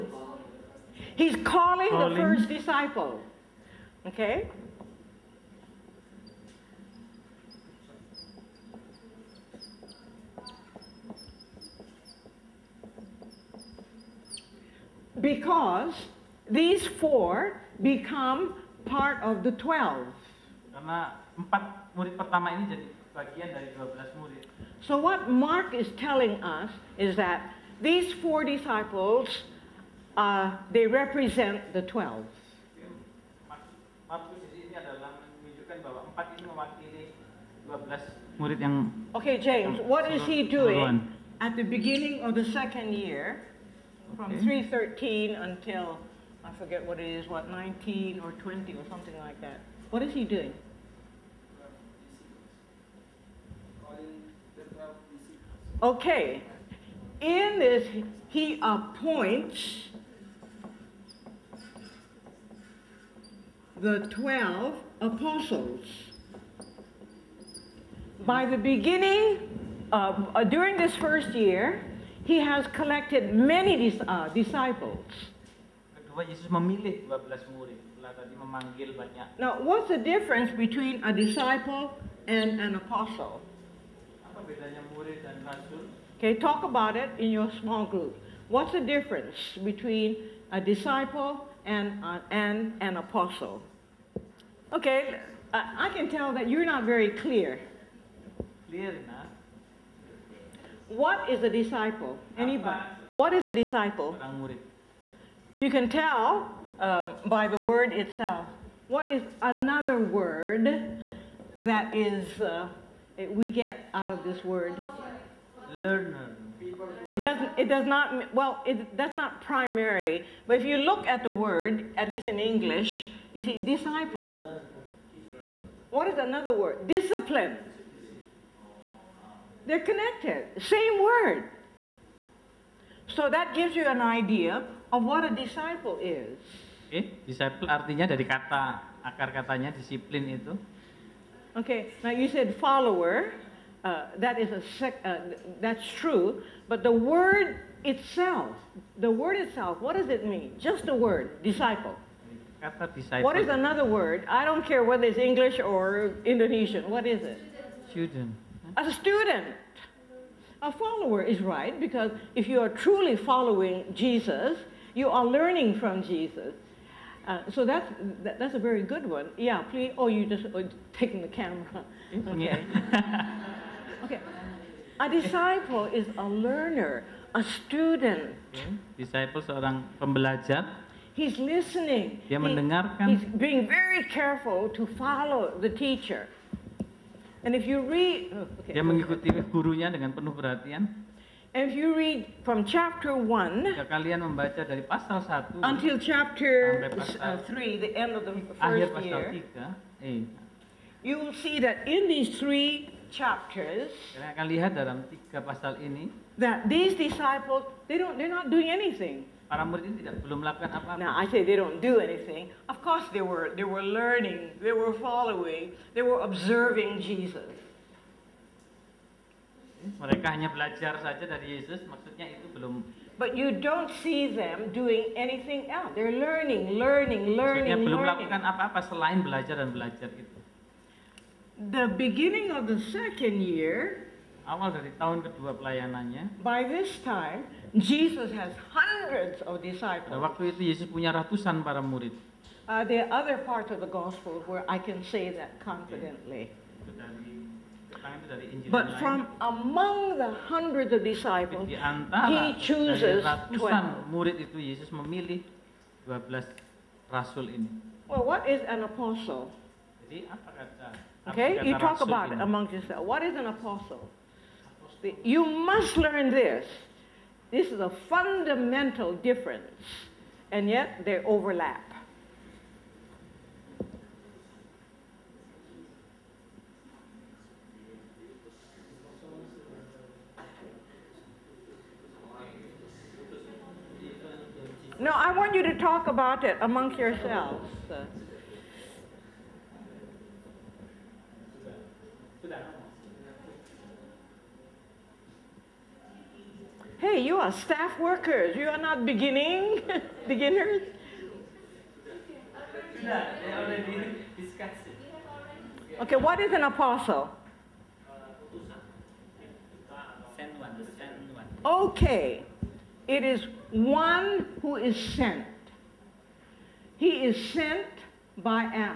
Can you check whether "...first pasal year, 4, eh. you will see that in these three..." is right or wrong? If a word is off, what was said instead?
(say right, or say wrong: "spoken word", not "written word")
wrong: "3", not "4".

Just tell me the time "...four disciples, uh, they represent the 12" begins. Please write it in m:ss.
0:28.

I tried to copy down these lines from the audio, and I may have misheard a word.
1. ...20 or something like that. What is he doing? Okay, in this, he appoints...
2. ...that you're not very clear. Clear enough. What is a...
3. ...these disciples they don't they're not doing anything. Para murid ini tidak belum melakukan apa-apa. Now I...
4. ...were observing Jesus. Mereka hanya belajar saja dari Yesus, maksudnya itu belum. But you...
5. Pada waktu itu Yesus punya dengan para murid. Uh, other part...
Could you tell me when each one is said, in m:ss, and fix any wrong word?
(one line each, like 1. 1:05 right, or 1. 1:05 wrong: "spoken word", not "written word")
1. 0:48 right
2. 1:36 right
3. 3:26 right
4. 3:36 right
5. 4:00 wrong: "ratusan", not "dengan".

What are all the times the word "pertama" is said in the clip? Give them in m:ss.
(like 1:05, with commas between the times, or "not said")
0:22.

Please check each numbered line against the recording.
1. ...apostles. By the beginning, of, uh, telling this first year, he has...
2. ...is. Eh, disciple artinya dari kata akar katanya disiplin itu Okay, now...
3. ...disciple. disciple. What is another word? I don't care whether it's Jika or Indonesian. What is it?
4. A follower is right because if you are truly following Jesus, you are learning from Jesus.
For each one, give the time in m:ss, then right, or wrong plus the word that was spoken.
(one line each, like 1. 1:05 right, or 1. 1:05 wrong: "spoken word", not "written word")
1. 1:04 wrong: "during", not "telling"
2. 2:15 right
3. 2:31 wrong: "English", not "Jika"
4. 2:40 right.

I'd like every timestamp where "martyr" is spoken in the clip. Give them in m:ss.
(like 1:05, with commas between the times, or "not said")
not said.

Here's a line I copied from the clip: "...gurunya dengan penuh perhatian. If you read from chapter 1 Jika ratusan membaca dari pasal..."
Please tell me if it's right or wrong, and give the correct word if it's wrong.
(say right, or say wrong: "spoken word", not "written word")
wrong: "kalian", not "ratusan".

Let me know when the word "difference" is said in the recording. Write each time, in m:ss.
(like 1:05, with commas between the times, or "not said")
1:19, 1:28, 4:29.